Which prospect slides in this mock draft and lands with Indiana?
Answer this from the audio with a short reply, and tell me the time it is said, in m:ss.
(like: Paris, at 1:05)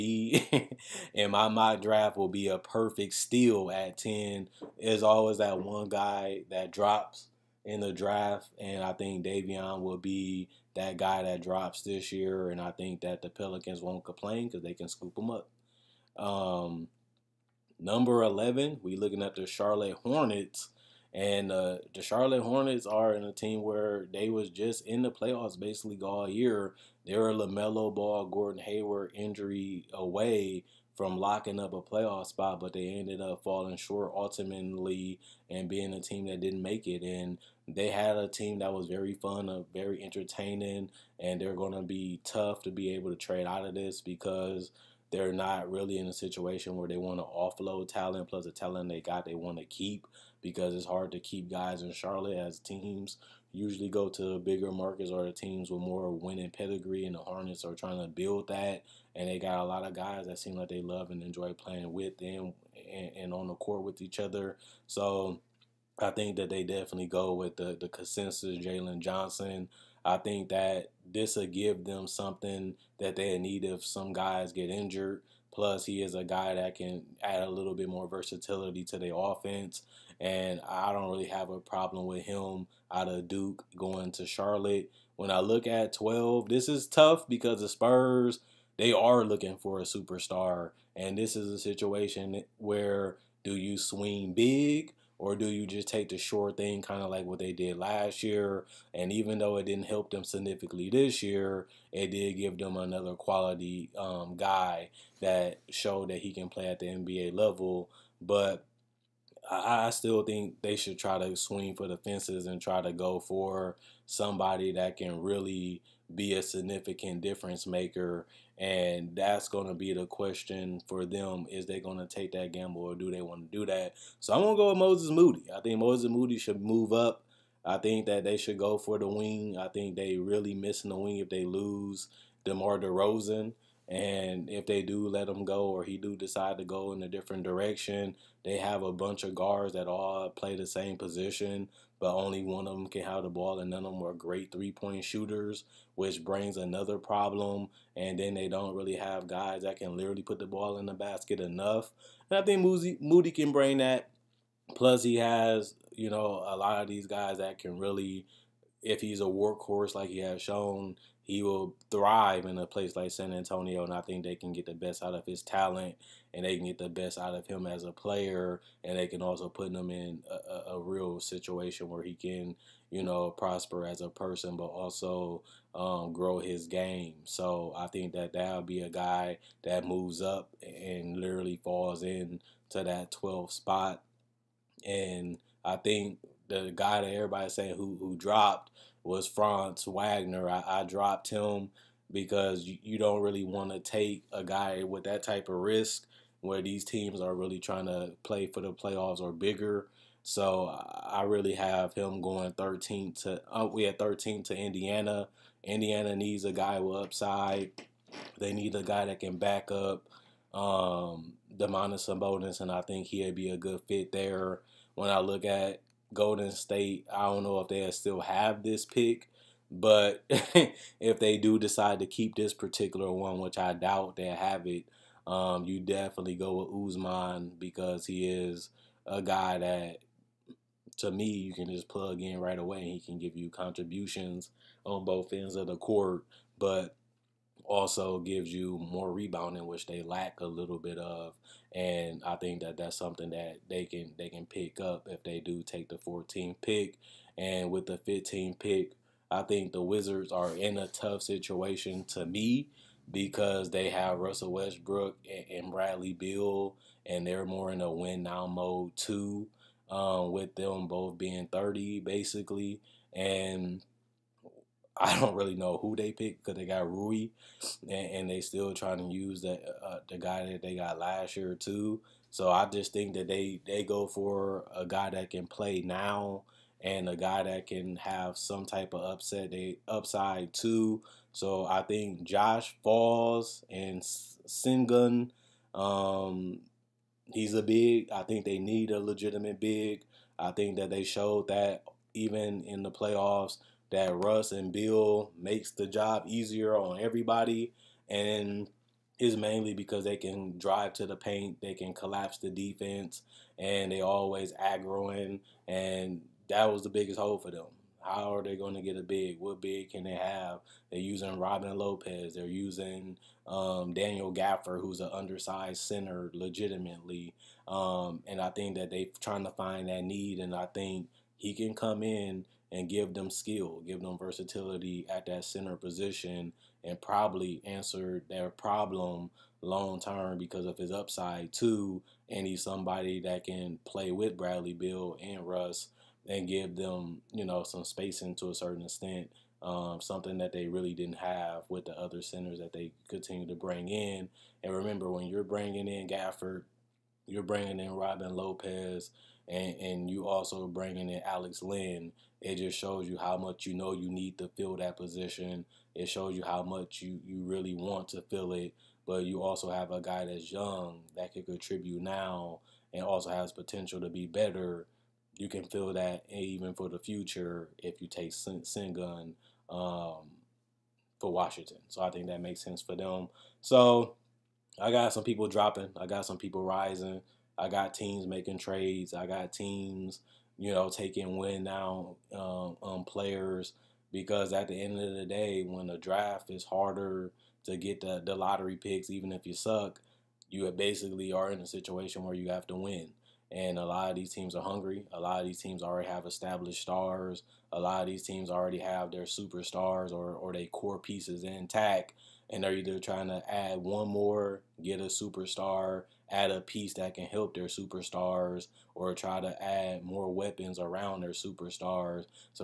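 Franz Wagner, at 3:09.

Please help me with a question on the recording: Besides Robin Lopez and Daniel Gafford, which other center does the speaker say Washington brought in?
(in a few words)
Alex Len.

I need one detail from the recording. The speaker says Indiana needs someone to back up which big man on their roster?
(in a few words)
Domantas Sabonis.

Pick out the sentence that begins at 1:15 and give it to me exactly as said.
Plus, he is a guy that can add a little bit more versatility to their offense.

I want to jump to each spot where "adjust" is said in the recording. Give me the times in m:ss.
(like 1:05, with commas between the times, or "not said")
not said.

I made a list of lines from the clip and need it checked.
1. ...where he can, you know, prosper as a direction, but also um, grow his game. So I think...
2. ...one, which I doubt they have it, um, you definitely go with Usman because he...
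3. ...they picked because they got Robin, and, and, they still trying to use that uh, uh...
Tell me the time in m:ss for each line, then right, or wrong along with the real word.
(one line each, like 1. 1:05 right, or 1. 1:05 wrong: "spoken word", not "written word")
1. 2:51 wrong: "person", not "direction"
2. 3:43 right
3. 4:25 wrong: "Rui", not "Robin".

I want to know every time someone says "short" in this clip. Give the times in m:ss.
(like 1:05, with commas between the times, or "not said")
0:33, 1:36.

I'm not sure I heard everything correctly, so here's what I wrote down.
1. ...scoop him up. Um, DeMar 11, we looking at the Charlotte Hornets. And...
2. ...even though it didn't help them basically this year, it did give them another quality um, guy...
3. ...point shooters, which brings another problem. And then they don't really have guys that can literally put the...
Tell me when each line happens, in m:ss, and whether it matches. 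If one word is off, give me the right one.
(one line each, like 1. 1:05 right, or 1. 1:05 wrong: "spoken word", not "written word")
1. 0:14 wrong: "Number", not "DeMar"
2. 1:39 wrong: "significantly", not "basically"
3. 2:24 right.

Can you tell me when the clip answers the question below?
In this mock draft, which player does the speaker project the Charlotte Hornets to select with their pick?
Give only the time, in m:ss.
1:08.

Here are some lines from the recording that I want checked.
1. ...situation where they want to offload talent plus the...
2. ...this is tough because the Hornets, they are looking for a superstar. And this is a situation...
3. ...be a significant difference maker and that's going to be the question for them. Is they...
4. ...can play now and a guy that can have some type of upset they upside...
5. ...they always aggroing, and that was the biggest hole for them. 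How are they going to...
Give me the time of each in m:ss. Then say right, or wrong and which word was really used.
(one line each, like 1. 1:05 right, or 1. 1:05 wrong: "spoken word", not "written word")
1. 0:46 right
2. 1:26 wrong: "Spurs", not "Hornets"
3. 1:56 right
4. 4:35 right
5. 5:03 right.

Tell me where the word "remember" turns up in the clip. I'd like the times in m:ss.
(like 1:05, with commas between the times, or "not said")
5:44.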